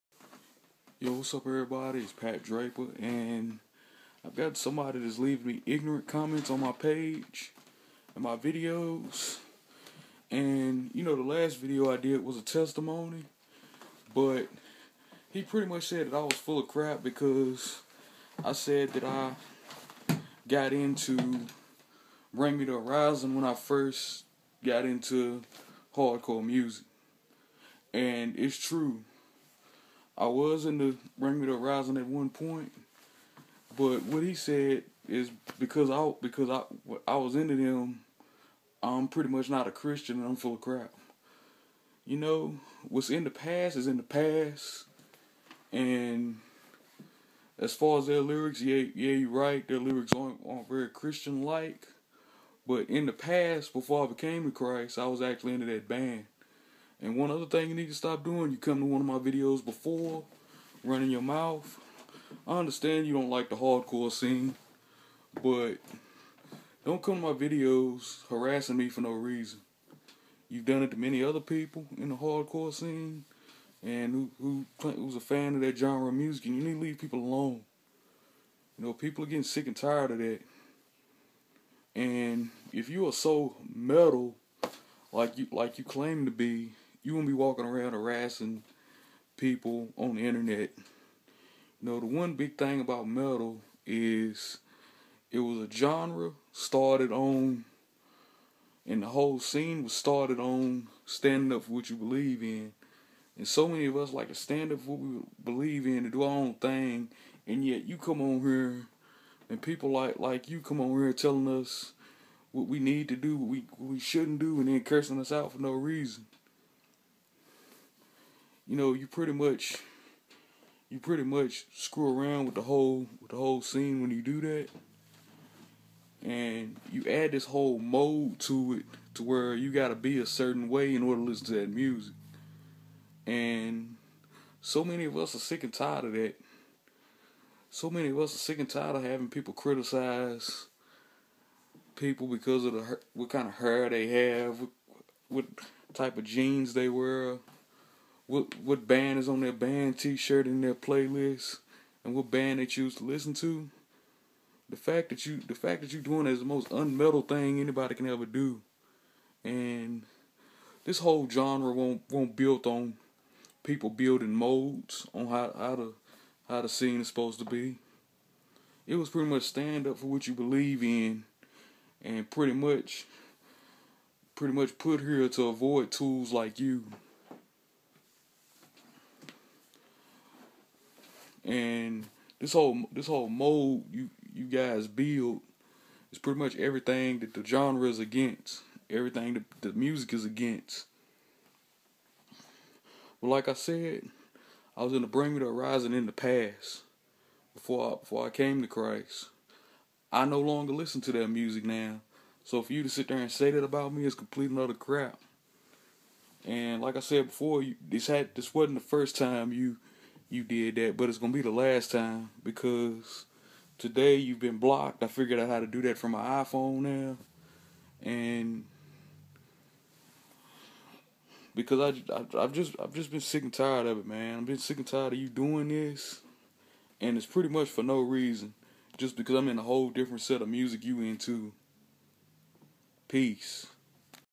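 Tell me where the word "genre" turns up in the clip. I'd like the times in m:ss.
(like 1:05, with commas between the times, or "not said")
1:15, 1:35, 2:41, 3:07.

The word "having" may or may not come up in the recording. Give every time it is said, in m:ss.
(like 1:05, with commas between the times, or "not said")
2:19.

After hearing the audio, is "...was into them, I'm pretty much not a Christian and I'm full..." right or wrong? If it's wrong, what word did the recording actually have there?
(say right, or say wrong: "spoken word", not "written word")
right.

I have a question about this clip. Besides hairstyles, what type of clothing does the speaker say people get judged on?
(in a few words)
jeans.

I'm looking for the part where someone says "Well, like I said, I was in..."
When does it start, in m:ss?
3:13.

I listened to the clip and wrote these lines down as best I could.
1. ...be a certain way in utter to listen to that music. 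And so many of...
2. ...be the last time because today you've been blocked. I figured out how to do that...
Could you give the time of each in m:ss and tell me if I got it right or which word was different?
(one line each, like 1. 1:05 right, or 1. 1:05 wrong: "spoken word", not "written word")
1. 2:09 wrong: "order", not "utter"
2. 3:31 right.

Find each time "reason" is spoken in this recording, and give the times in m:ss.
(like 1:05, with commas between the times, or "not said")
1:09, 1:55, 3:47.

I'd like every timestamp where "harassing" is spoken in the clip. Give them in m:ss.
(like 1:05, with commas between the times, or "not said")
1:08, 1:27.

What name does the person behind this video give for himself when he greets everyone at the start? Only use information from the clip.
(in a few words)
Pat Draven.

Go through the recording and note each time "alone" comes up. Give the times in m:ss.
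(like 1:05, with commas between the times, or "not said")
1:17.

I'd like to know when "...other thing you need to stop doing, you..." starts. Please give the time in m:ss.
0:57.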